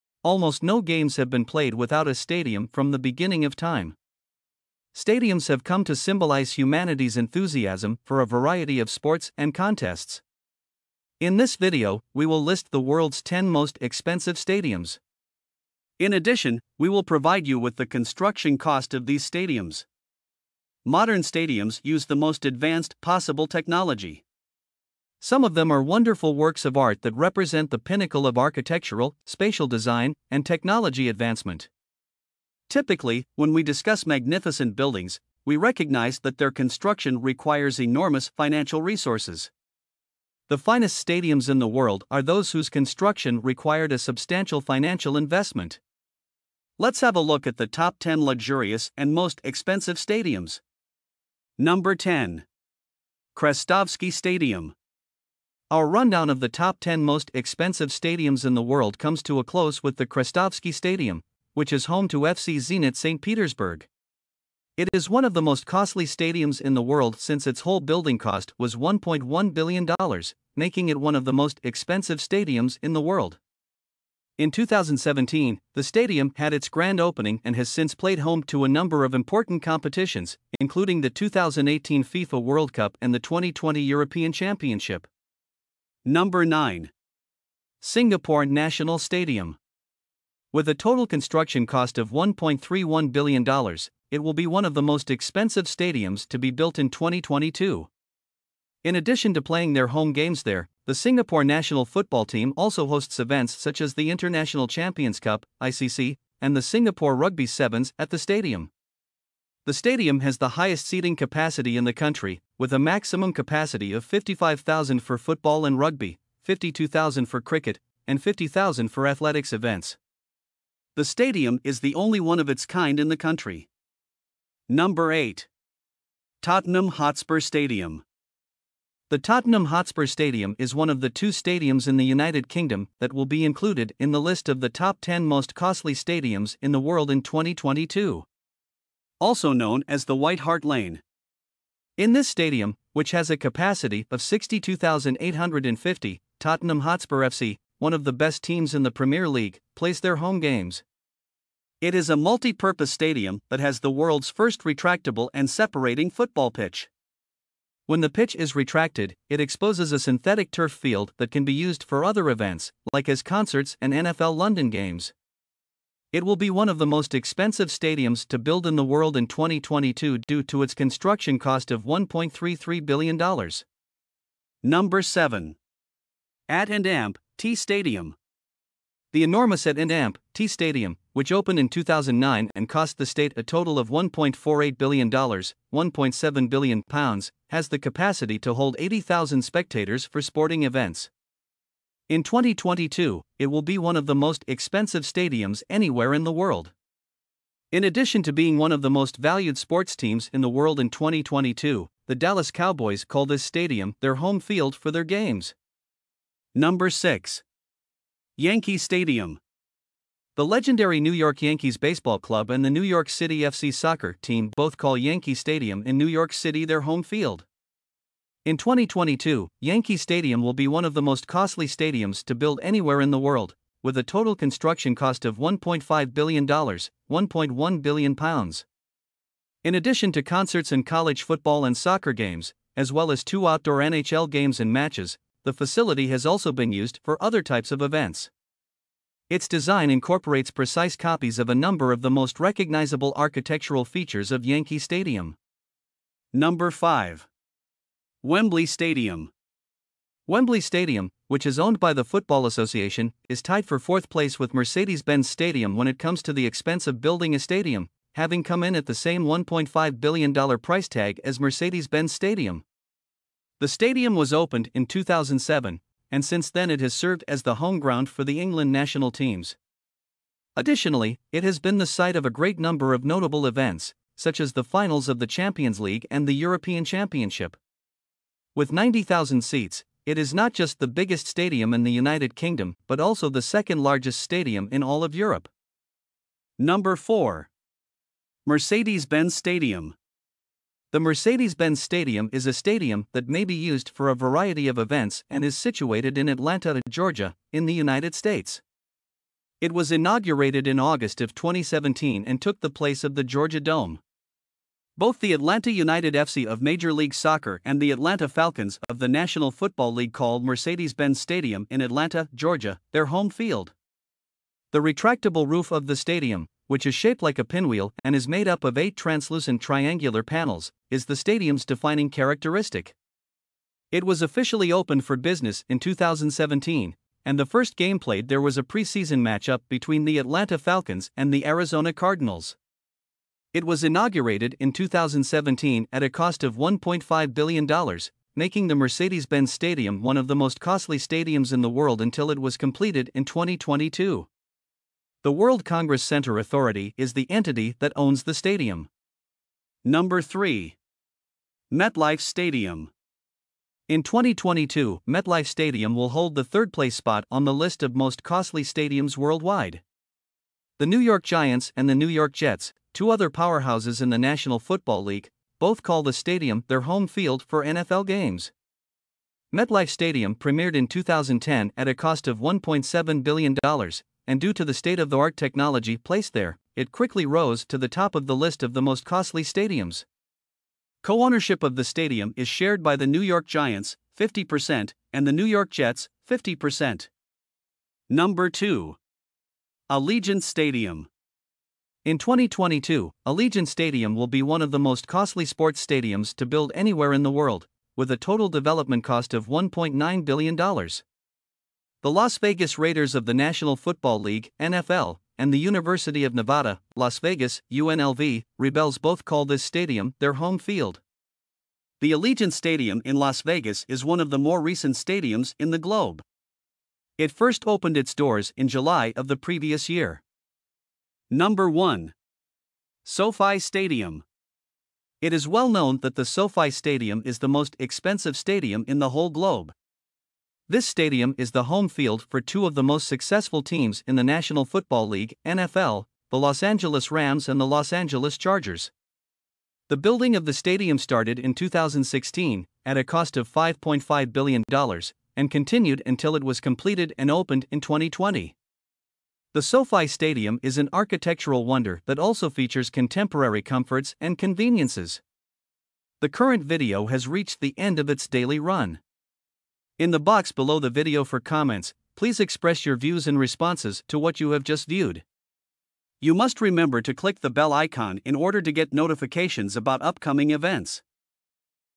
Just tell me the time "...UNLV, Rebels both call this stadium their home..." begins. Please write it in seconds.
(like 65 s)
407 s.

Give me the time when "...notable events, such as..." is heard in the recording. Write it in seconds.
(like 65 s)
273 s.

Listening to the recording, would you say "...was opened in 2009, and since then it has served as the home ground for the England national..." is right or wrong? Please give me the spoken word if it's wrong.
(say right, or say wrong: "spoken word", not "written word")
wrong: "2007", not "2009".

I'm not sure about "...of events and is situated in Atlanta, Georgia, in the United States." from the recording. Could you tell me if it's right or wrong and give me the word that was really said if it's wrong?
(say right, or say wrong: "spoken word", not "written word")
right.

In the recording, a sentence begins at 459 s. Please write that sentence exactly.
In the box below the video for comments, please express your views and responses to what you have just viewed.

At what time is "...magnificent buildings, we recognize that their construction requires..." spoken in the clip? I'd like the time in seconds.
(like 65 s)
34 s.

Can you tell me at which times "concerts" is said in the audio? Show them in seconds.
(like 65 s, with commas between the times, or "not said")
163 s, 230 s.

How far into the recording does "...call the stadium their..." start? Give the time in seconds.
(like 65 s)
365 s.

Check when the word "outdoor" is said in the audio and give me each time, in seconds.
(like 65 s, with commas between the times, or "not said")
233 s.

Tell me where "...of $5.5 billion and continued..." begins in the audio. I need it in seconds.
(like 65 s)
443 s.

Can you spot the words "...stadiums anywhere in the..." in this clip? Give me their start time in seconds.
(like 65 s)
195 s.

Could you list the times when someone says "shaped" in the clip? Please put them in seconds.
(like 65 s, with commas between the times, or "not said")
316 s.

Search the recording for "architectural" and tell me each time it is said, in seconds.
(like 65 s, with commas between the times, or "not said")
28 s, 243 s, 450 s.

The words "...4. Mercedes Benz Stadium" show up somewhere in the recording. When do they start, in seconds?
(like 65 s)
286 s.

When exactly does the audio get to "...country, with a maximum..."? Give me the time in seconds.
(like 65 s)
111 s.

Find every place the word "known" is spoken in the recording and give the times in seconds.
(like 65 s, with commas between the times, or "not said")
139 s, 425 s.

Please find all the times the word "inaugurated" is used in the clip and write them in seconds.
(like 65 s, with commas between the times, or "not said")
299 s, 333 s.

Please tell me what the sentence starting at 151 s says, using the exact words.
It is a multi purpose stadium that has the world's first retractable and separating football pitch.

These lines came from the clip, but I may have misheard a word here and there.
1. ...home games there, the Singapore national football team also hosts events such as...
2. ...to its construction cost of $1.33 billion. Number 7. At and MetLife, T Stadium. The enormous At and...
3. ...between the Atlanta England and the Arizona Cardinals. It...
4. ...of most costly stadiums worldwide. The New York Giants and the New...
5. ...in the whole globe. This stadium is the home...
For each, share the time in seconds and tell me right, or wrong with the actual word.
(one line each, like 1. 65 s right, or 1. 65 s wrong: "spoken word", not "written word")
1. 99 s right
2. 170 s wrong: "Amp", not "MetLife"
3. 329 s wrong: "Falcons", not "England"
4. 357 s right
5. 428 s right.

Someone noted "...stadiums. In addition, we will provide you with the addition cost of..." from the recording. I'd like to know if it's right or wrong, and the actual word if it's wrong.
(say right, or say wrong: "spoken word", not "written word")
wrong: "construction", not "addition".